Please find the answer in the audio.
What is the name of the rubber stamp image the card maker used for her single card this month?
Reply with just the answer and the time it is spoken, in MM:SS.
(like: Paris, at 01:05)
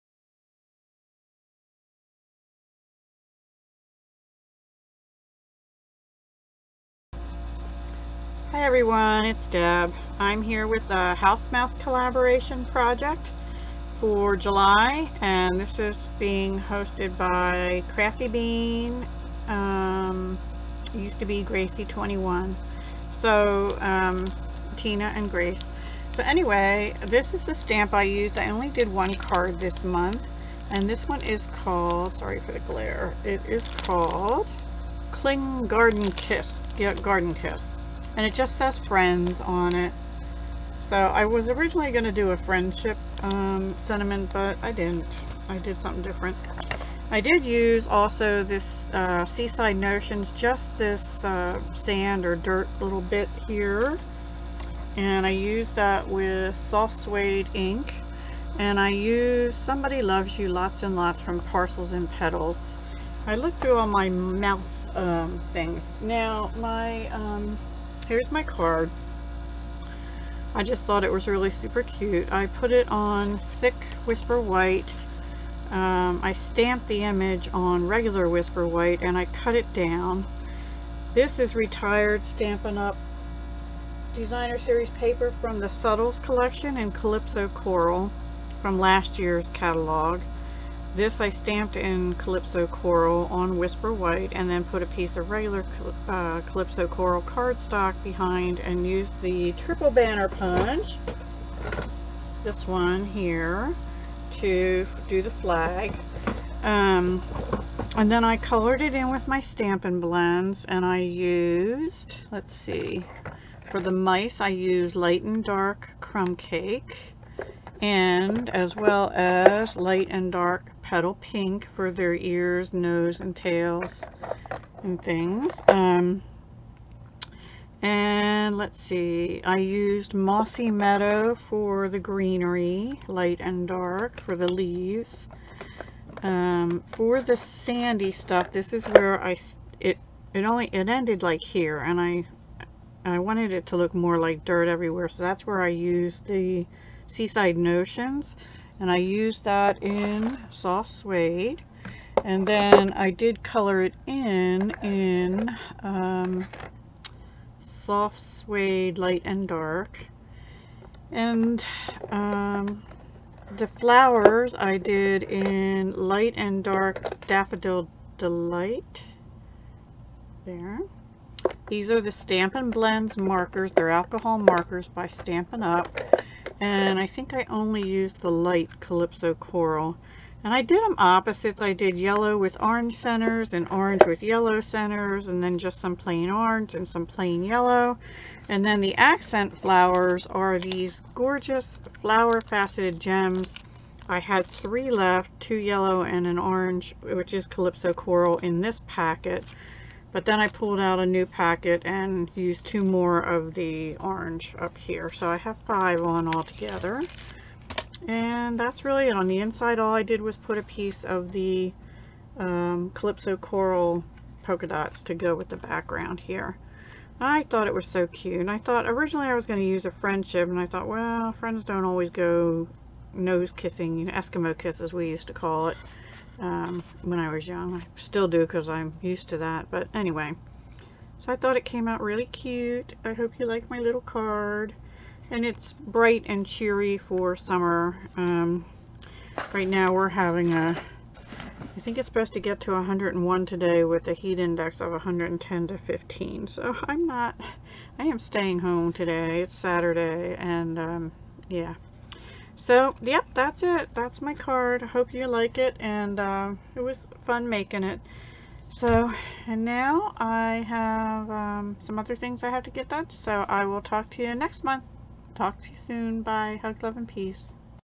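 Garden Kiss, at 00:35.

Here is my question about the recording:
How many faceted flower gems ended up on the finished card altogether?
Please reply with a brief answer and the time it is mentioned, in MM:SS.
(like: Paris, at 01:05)
5, at 03:25.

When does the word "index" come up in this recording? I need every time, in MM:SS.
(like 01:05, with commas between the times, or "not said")
04:04.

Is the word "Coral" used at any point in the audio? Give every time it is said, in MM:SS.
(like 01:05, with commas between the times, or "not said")
01:27, 01:32, 01:36, 02:59, 03:17, 03:33.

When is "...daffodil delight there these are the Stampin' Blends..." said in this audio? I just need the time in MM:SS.
02:47.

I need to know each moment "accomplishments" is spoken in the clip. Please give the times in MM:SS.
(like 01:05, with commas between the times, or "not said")
not said.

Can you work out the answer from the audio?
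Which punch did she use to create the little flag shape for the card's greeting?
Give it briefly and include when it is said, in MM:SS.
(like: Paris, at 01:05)
triple banner punch, at 01:39.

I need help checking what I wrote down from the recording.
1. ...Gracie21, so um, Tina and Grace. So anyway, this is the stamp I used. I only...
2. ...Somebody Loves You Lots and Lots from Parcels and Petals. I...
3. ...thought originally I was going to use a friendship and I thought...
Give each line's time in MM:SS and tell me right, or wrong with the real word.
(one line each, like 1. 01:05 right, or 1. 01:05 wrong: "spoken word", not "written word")
1. 00:21 right
2. 00:59 right
3. 03:38 right.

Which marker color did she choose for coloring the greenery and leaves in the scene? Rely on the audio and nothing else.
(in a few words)
Mossy Meadow.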